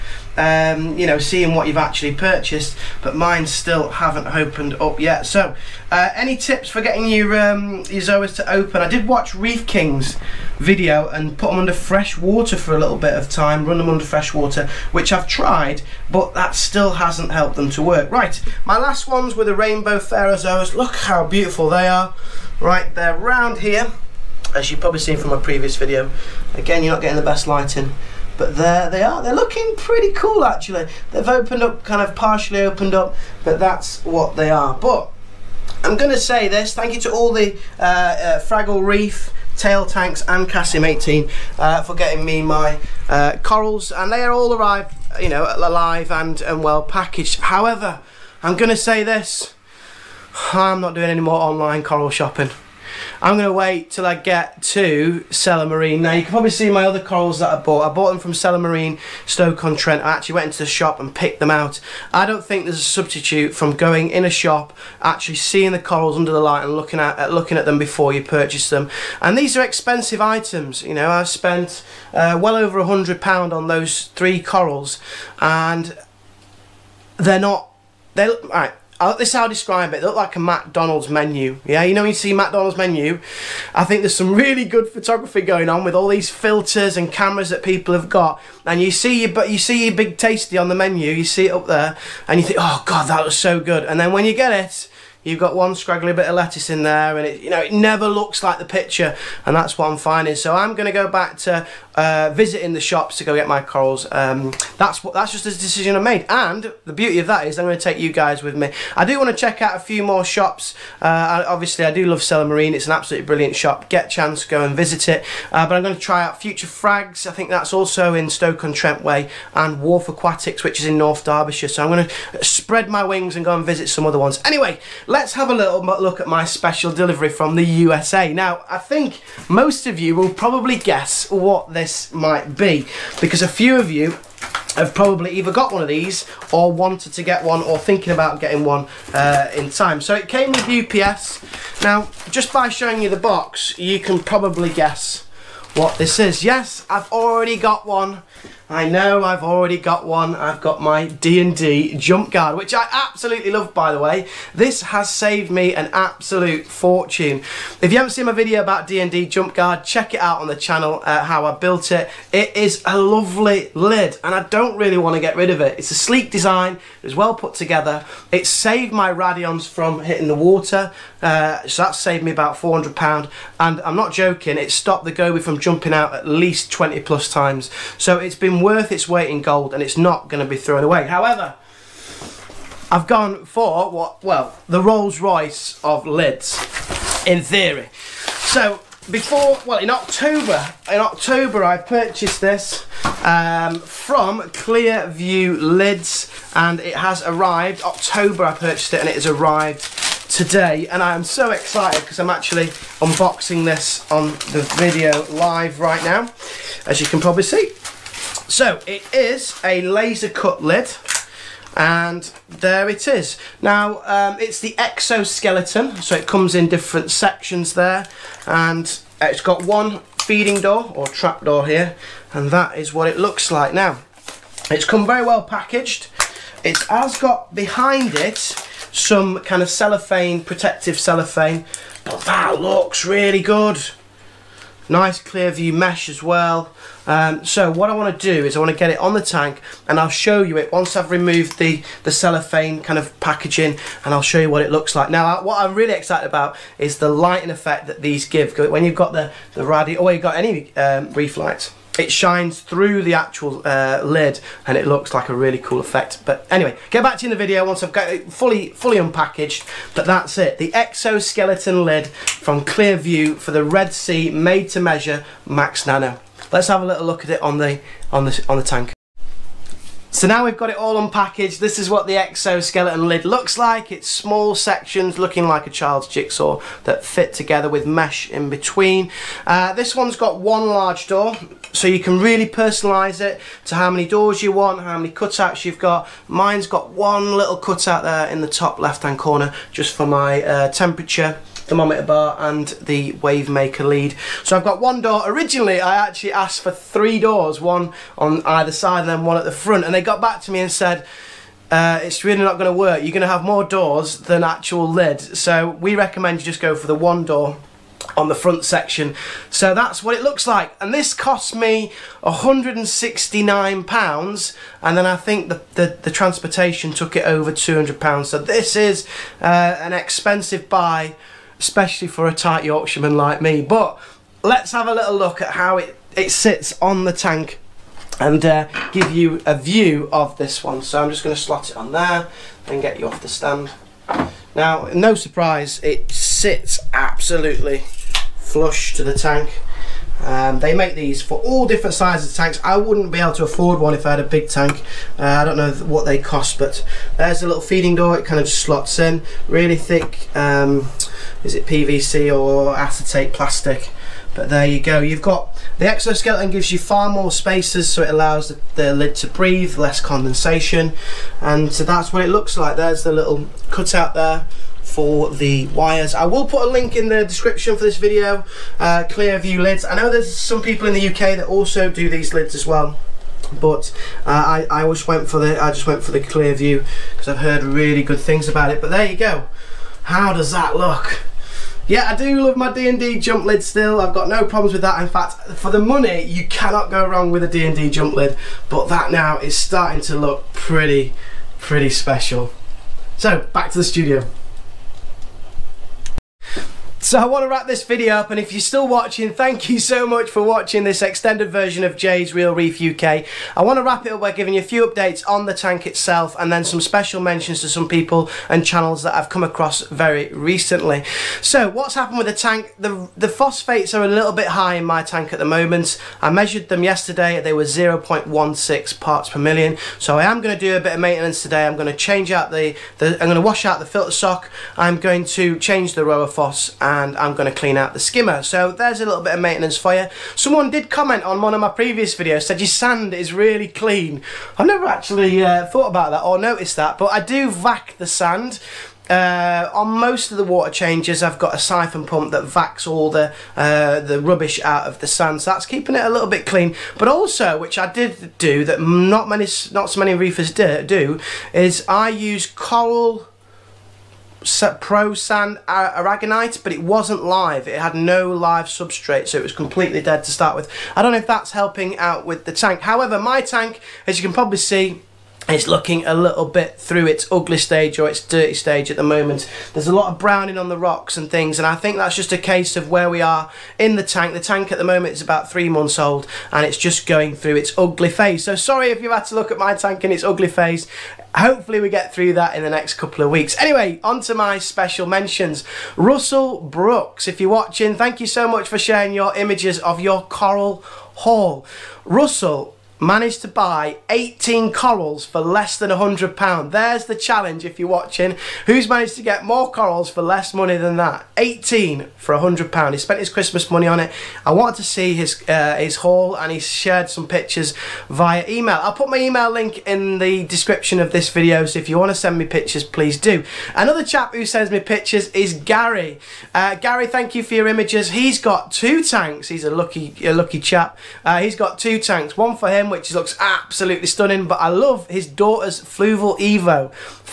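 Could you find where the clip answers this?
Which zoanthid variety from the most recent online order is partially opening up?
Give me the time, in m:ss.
0:19.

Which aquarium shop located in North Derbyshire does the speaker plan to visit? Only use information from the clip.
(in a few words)
Wharf Aquatics.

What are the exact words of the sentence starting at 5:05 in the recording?
So we recommend you just go for the one door on the front section.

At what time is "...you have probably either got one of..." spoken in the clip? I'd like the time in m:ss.
2:13.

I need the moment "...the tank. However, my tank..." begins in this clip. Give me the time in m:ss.
7:42.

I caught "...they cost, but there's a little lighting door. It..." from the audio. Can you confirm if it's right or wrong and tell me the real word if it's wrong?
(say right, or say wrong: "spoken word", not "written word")
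wrong: "feeding", not "lighting".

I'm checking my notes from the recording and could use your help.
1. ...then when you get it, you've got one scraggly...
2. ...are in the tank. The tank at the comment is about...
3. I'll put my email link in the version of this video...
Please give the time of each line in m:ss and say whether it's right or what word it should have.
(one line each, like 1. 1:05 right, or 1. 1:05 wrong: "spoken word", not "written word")
1. 1:33 right
2. 7:53 wrong: "moment", not "comment"
3. 8:28 wrong: "description", not "version".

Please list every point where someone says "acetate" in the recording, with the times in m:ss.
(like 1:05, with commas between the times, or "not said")
5:52.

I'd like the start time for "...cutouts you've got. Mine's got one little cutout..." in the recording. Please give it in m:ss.
4:45.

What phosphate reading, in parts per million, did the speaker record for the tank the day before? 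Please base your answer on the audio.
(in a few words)
0.16.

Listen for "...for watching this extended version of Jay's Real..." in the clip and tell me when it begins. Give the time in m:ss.
6:40.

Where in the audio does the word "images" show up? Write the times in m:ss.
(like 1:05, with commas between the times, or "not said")
8:09, 8:37.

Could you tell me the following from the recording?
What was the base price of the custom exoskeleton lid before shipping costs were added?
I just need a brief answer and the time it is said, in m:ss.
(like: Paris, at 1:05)
£169, at 5:12.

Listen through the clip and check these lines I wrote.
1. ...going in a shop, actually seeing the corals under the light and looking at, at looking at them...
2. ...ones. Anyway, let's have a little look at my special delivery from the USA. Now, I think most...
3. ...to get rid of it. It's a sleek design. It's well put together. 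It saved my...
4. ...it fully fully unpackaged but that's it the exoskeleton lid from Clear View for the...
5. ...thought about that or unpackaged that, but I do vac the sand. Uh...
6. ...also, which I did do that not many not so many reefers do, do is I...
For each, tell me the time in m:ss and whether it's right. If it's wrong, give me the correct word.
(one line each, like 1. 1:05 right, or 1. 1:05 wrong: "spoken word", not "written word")
1. 1:03 right
2. 2:04 right
3. 2:45 right
4. 4:18 right
5. 7:15 wrong: "noticed", not "unpackaged"
6. 7:27 right.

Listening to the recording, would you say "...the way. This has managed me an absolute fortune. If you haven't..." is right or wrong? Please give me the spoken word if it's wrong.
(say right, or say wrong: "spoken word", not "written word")
wrong: "saved", not "managed".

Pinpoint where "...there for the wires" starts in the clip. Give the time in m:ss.
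6:04.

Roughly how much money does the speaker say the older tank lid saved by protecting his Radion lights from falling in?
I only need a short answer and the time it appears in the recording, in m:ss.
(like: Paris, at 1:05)
£400, at 2:52.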